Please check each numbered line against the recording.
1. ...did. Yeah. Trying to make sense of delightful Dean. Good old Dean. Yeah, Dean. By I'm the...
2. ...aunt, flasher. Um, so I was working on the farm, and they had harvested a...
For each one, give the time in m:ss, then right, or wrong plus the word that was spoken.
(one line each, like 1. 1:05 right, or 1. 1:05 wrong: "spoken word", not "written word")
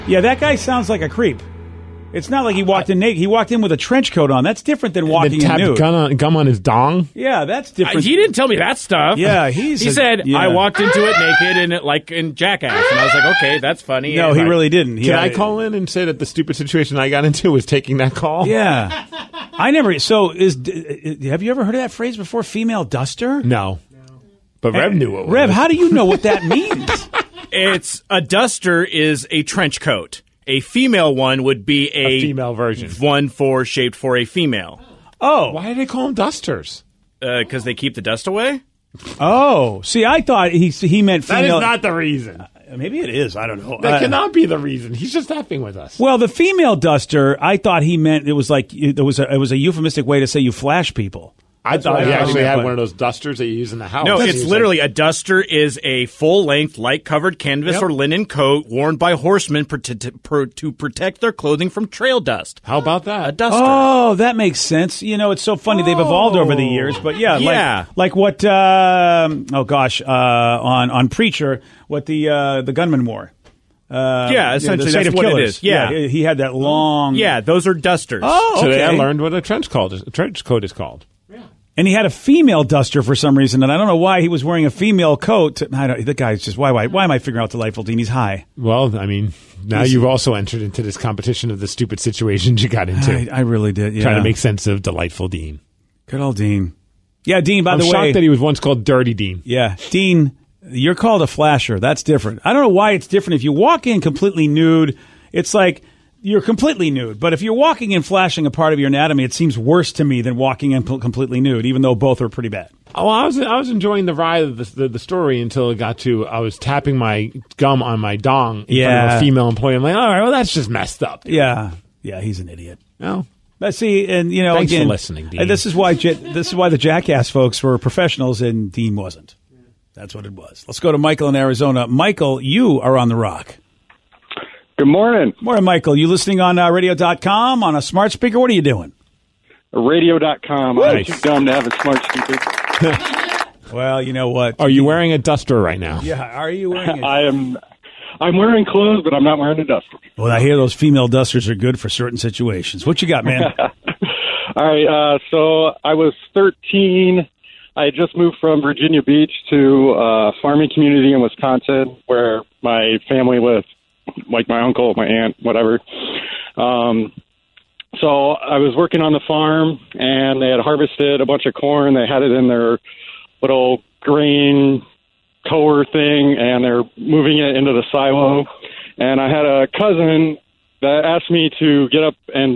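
1. 1:33 right
2. 2:45 wrong: "whatever", not "flasher".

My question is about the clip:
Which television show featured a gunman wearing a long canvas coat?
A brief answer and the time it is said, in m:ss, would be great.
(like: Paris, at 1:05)
Preacher, at 1:11.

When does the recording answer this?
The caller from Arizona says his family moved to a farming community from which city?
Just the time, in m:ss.
2:38.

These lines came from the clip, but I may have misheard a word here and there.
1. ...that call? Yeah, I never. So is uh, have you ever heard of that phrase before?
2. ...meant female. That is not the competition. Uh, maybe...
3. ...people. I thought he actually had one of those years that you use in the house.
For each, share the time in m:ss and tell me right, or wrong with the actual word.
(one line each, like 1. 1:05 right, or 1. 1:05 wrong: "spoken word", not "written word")
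1. 0:17 right
2. 0:41 wrong: "reason", not "competition"
3. 0:50 wrong: "dusters", not "years".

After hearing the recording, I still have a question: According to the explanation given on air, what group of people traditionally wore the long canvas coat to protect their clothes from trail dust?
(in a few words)
Horsemen.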